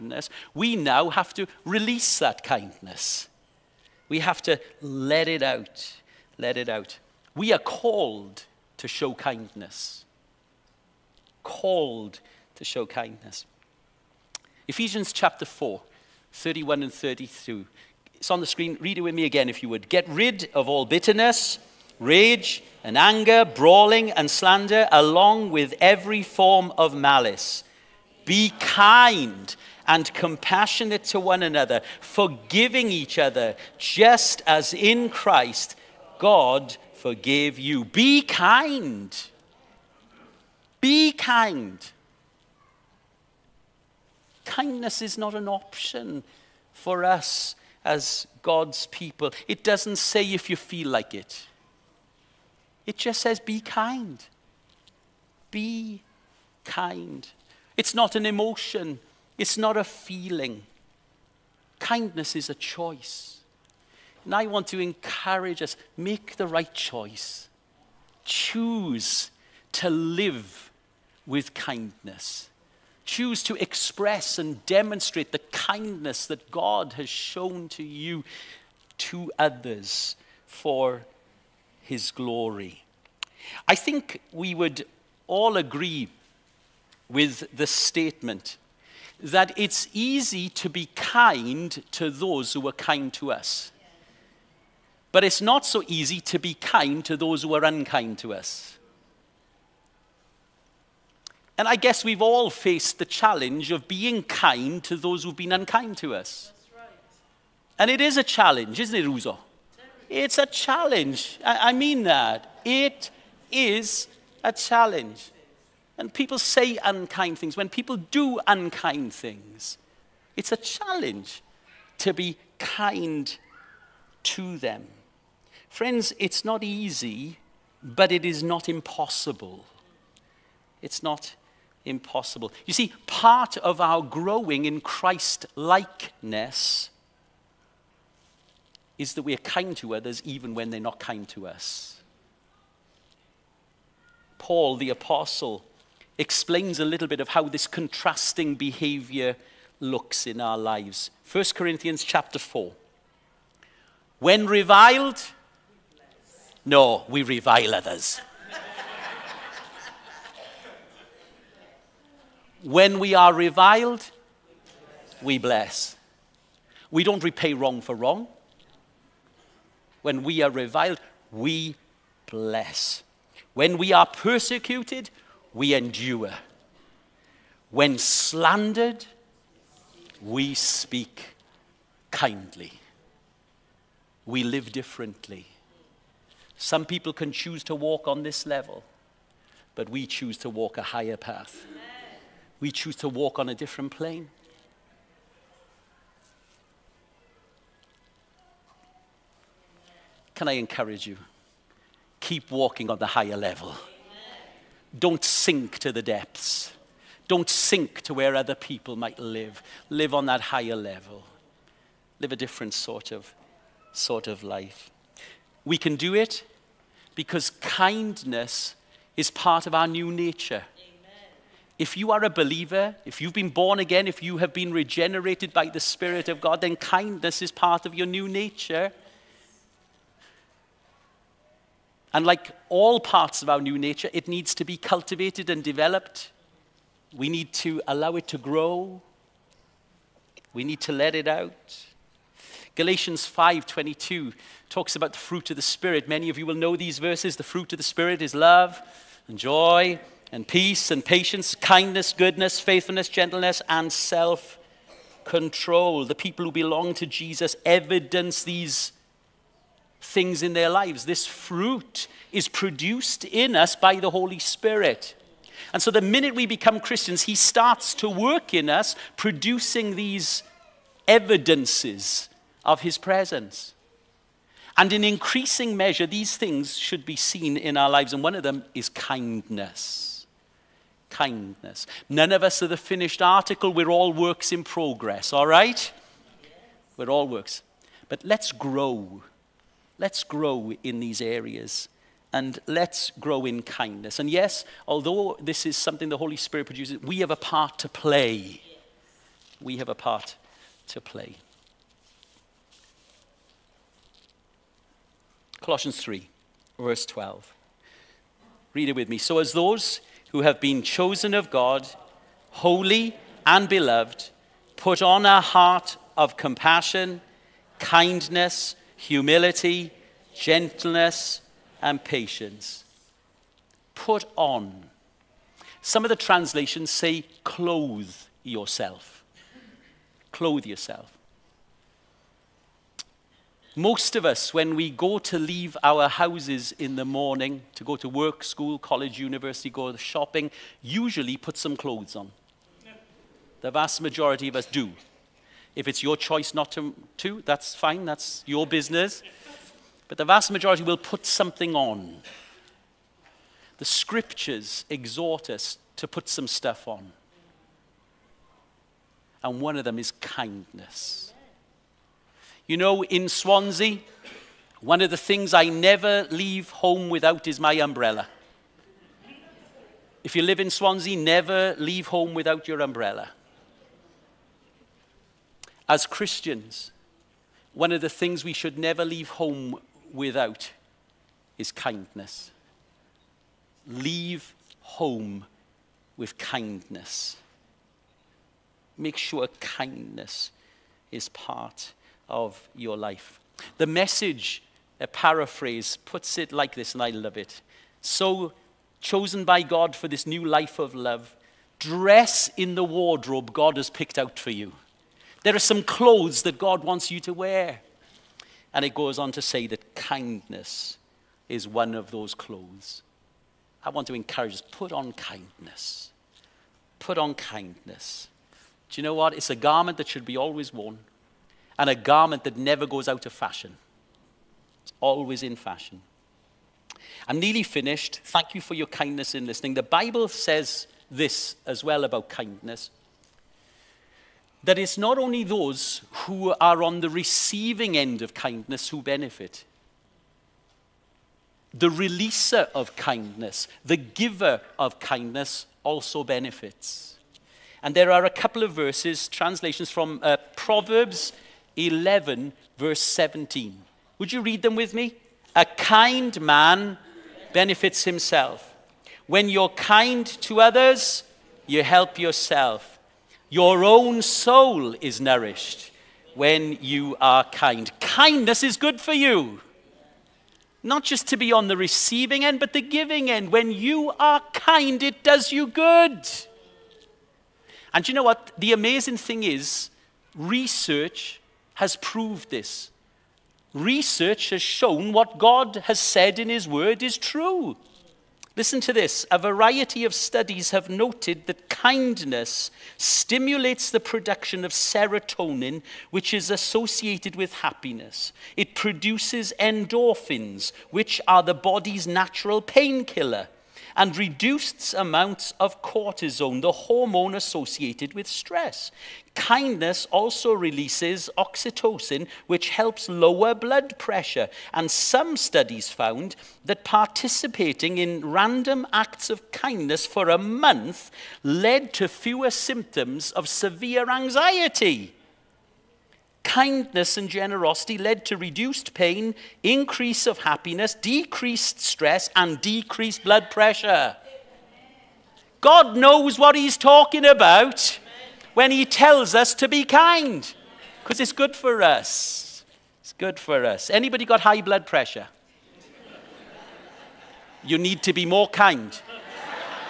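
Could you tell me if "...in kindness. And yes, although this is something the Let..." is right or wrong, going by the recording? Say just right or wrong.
wrong.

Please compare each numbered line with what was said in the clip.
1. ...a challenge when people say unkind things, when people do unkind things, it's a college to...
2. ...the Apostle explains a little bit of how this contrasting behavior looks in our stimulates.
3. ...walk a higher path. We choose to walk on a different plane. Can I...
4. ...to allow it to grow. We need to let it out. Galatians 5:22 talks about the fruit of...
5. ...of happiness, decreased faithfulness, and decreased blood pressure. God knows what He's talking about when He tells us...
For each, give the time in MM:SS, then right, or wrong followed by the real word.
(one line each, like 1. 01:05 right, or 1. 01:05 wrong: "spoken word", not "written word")
1. 01:54 wrong: "challenge", not "college"
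2. 02:24 wrong: "lives", not "stimulates"
3. 03:10 right
4. 03:57 right
5. 08:50 wrong: "stress", not "faithfulness".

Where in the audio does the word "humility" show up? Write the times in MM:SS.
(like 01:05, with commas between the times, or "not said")
05:19.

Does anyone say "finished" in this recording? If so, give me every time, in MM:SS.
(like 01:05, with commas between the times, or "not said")
04:42, 07:07.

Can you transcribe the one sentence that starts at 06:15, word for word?
As Christians, one of the things we should never leave home without is kindness.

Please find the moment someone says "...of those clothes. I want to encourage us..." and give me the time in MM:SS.
06:51.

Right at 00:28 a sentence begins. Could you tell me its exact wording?
Be kind and compassionate to one another, forgiving each other, just as in Christ God forgave you.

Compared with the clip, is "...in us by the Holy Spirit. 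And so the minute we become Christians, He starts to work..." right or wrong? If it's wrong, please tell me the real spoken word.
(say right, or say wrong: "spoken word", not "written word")
right.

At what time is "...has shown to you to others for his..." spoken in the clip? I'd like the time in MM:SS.
01:16.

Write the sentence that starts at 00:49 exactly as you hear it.
It doesn't say if you feel like it, it just says be kind.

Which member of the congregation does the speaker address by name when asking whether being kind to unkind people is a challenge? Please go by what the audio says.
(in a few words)
Uzo.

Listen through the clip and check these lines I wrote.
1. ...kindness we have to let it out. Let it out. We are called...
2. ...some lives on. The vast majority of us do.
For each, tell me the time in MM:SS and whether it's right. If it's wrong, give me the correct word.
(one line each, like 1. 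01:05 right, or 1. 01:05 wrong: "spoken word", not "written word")
1. 00:02 right
2. 05:41 wrong: "clothes", not "lives".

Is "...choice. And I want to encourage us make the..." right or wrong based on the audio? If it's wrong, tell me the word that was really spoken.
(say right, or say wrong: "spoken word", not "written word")
right.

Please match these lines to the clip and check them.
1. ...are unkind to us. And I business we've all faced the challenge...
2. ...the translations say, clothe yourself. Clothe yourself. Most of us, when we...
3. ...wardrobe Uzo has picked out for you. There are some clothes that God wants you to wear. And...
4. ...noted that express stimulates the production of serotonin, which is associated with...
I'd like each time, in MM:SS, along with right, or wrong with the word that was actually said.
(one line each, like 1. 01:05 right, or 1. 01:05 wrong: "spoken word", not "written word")
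1. 01:37 wrong: "guess", not "business"
2. 05:26 right
3. 06:42 wrong: "God", not "Uzo"
4. 08:10 wrong: "kindness", not "express".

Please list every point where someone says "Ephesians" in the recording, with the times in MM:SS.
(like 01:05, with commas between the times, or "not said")
00:14.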